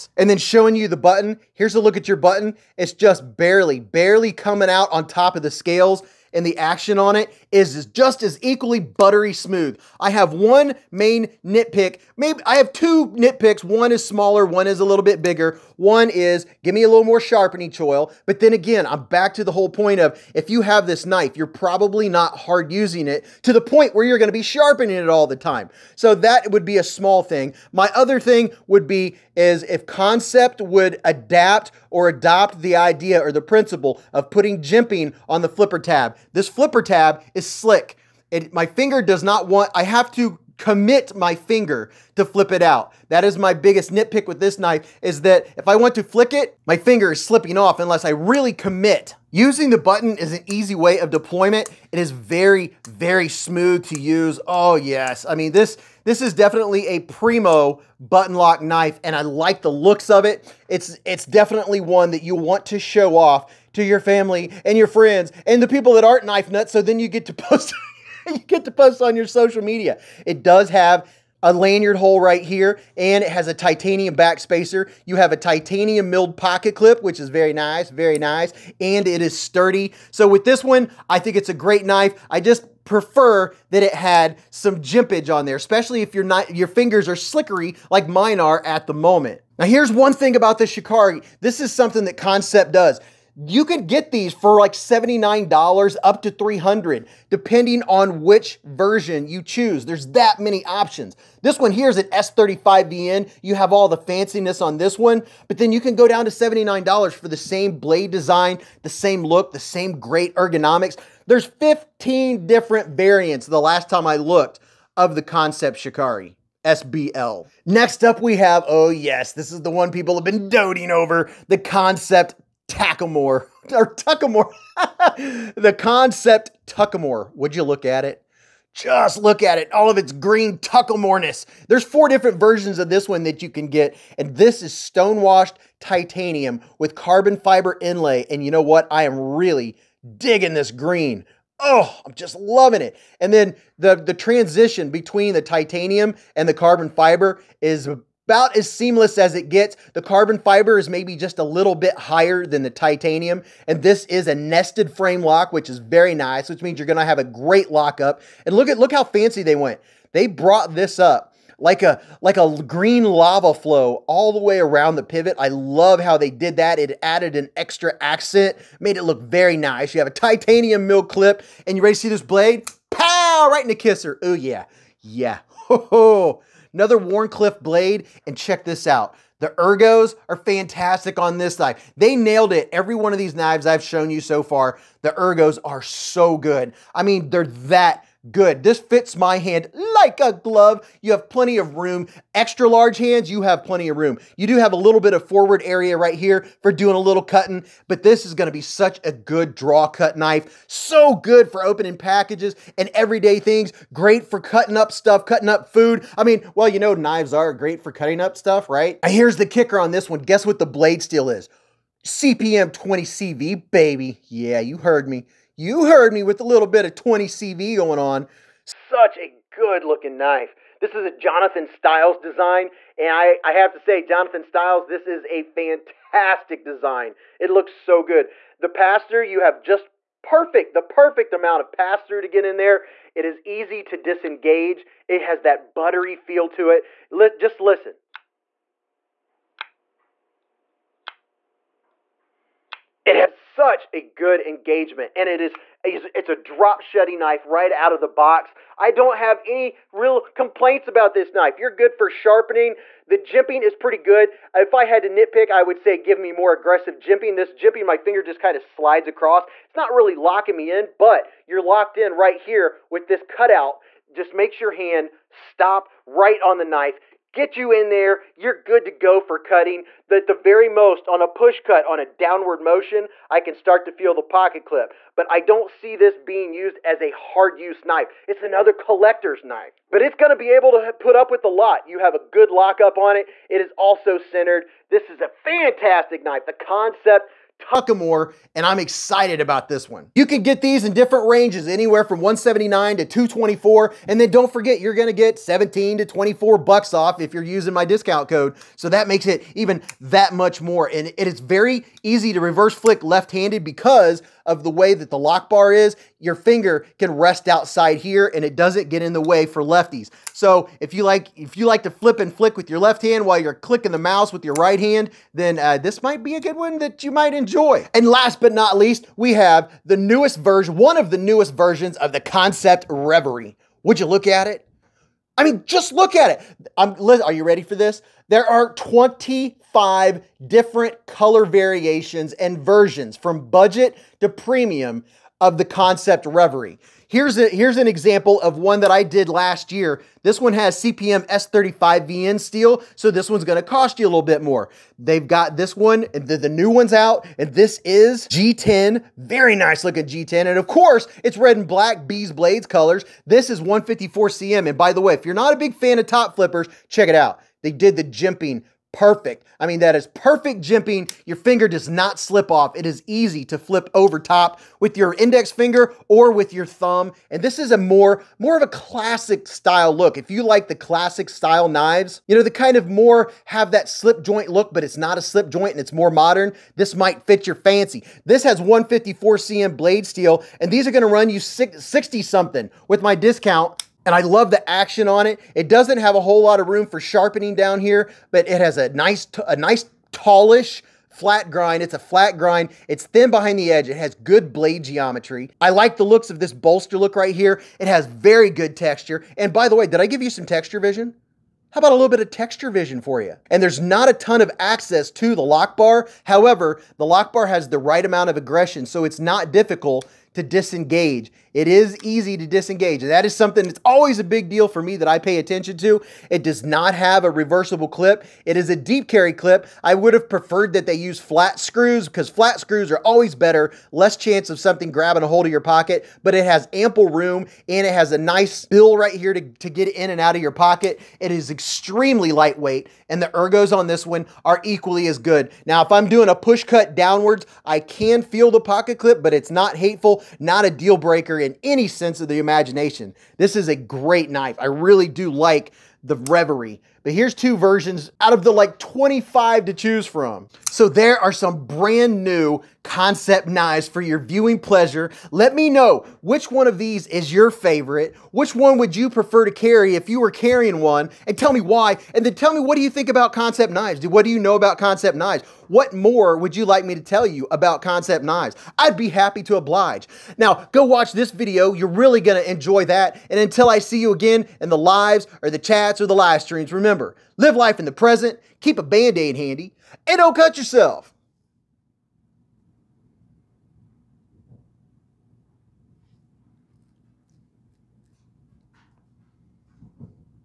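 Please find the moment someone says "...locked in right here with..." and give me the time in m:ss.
4:21.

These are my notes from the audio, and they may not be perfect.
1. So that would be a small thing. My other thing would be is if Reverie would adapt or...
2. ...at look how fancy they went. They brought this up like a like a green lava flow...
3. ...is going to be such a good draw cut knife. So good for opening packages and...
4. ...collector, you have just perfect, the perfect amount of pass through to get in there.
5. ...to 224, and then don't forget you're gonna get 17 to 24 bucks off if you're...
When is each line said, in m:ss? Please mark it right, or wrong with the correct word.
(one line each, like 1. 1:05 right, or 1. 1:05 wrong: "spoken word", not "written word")
1. 0:25 wrong: "Kansept", not "Reverie"
2. 2:38 right
3. 3:18 right
4. 3:48 wrong: "pastor", not "collector"
5. 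4:52 right.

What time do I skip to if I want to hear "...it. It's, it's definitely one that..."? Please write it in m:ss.
1:00.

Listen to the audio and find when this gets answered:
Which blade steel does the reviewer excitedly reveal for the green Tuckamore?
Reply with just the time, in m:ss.
3:32.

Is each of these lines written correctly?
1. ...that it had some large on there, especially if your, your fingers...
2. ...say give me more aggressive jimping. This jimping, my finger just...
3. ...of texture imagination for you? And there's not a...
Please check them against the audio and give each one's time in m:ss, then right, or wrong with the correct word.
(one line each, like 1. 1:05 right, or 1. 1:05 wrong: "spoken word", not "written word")
1. 1:23 wrong: "jimpage", not "large"
2. 4:15 right
3. 6:42 wrong: "vision", not "imagination".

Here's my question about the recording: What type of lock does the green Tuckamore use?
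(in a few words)
Nested frame lock.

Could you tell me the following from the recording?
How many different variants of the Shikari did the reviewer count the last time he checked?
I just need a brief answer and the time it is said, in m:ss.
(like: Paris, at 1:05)
15, at 1:51.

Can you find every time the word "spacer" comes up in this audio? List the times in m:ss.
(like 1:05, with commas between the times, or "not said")
1:14.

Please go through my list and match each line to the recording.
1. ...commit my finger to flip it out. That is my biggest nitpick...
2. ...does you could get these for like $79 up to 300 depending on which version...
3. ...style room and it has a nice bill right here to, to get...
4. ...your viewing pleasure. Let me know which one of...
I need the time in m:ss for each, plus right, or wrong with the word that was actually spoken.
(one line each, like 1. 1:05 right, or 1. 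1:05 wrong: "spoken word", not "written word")
1. 0:40 right
2. 1:32 right
3. 7:06 wrong: "ample", not "style"
4. 7:33 right.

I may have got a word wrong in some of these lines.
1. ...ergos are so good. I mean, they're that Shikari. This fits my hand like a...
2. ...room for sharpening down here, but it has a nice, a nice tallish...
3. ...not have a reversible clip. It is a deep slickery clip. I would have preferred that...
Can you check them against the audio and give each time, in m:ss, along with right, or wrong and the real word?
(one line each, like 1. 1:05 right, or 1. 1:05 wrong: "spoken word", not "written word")
1. 3:05 wrong: "Good", not "Shikari"
2. 6:26 right
3. 6:56 wrong: "carry", not "slickery".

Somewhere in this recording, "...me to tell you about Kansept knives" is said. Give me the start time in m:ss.
7:46.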